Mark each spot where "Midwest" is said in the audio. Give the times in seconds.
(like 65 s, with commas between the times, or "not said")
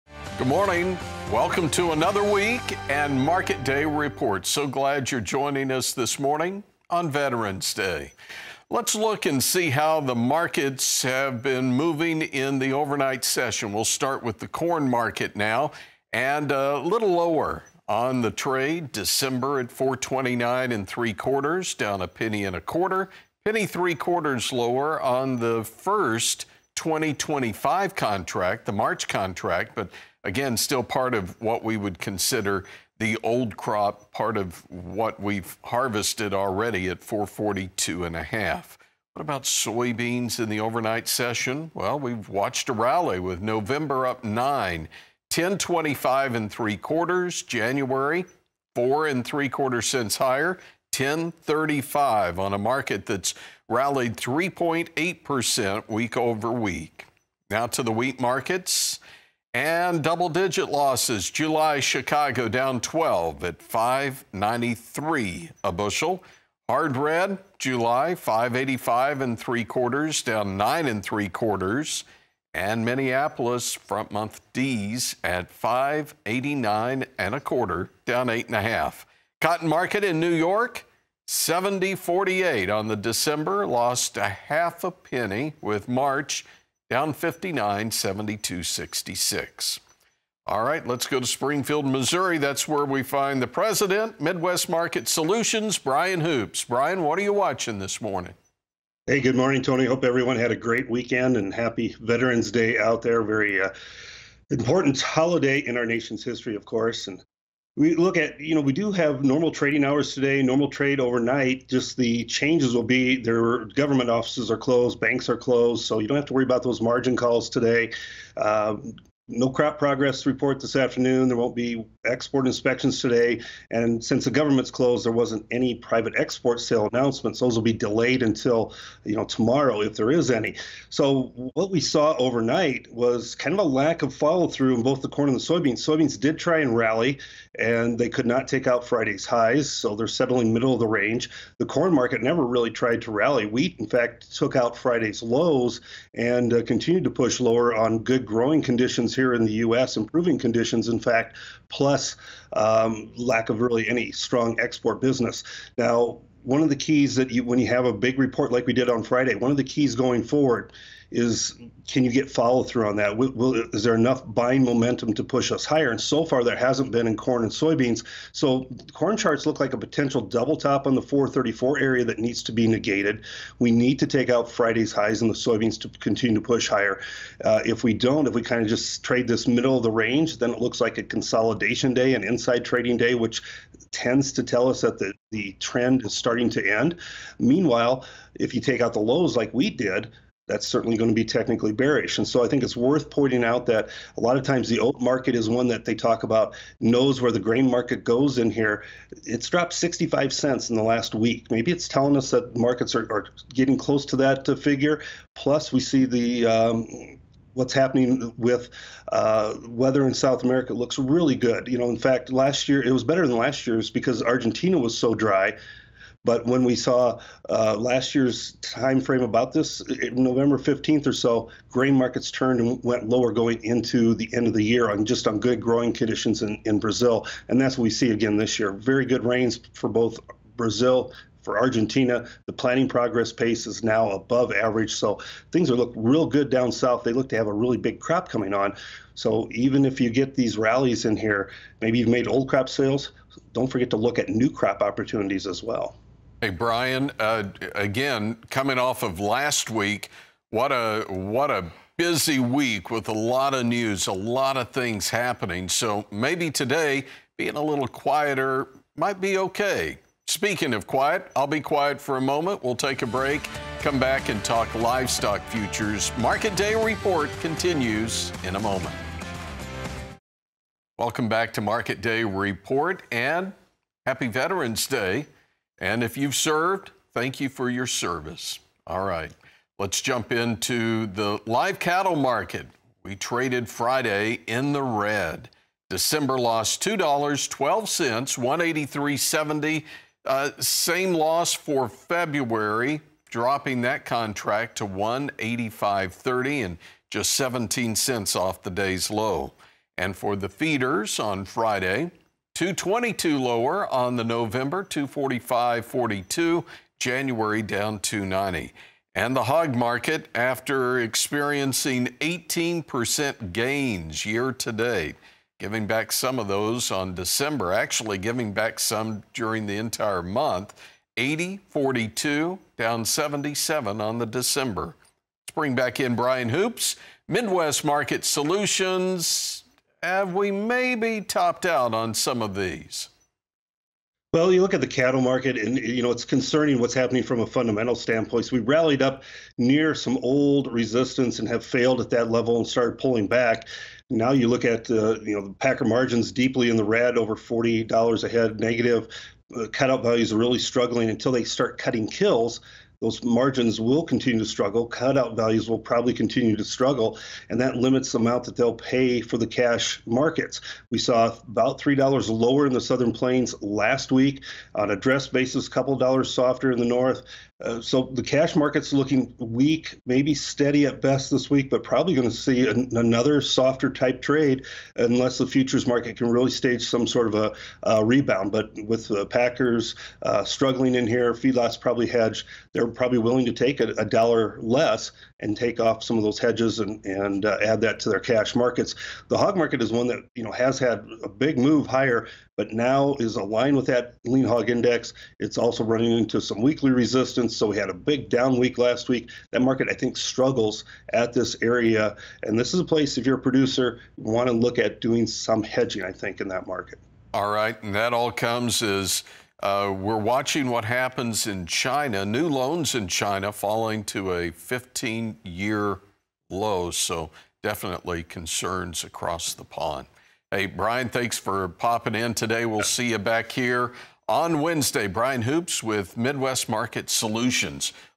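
94 s, 327 s, 426 s.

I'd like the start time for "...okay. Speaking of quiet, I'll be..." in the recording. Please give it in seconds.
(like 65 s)
259 s.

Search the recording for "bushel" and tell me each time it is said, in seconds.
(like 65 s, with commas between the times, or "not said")
65 s.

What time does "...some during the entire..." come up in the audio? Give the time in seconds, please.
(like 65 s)
318 s.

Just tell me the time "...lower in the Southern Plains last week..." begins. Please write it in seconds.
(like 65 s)
362 s.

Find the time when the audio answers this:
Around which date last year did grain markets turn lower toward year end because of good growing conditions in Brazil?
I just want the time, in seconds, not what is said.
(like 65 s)
220 s.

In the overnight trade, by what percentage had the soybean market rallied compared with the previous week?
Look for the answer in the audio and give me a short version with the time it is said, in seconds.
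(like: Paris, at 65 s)
3.8%, at 54 s.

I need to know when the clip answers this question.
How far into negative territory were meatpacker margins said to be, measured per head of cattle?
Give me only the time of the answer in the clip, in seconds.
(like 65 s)
347 s.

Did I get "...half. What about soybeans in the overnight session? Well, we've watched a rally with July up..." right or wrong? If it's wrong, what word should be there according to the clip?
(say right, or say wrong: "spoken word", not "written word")
wrong: "November", not "July".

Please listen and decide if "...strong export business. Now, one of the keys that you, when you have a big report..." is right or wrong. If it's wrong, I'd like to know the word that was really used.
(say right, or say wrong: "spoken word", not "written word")
right.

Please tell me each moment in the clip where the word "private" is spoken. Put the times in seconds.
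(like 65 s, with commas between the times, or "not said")
125 s.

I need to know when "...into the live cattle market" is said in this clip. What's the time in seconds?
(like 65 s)
280 s.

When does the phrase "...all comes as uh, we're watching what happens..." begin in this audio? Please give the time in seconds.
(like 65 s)
408 s.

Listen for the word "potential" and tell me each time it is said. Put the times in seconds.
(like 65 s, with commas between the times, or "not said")
169 s.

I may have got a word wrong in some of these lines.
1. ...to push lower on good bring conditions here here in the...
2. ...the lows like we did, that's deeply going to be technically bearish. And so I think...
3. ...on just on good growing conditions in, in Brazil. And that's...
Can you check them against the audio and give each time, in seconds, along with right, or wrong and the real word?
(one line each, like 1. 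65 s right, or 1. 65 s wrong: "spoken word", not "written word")
1. 147 s wrong: "growing", not "bring"
2. 188 s wrong: "certainly", not "deeply"
3. 224 s right.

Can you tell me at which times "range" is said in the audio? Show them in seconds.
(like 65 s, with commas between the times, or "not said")
140 s, 179 s.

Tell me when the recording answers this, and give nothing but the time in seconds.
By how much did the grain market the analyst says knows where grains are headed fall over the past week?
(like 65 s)
199 s.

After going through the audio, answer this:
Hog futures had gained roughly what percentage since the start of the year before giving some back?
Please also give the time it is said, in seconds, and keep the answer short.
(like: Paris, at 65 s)
18%, at 312 s.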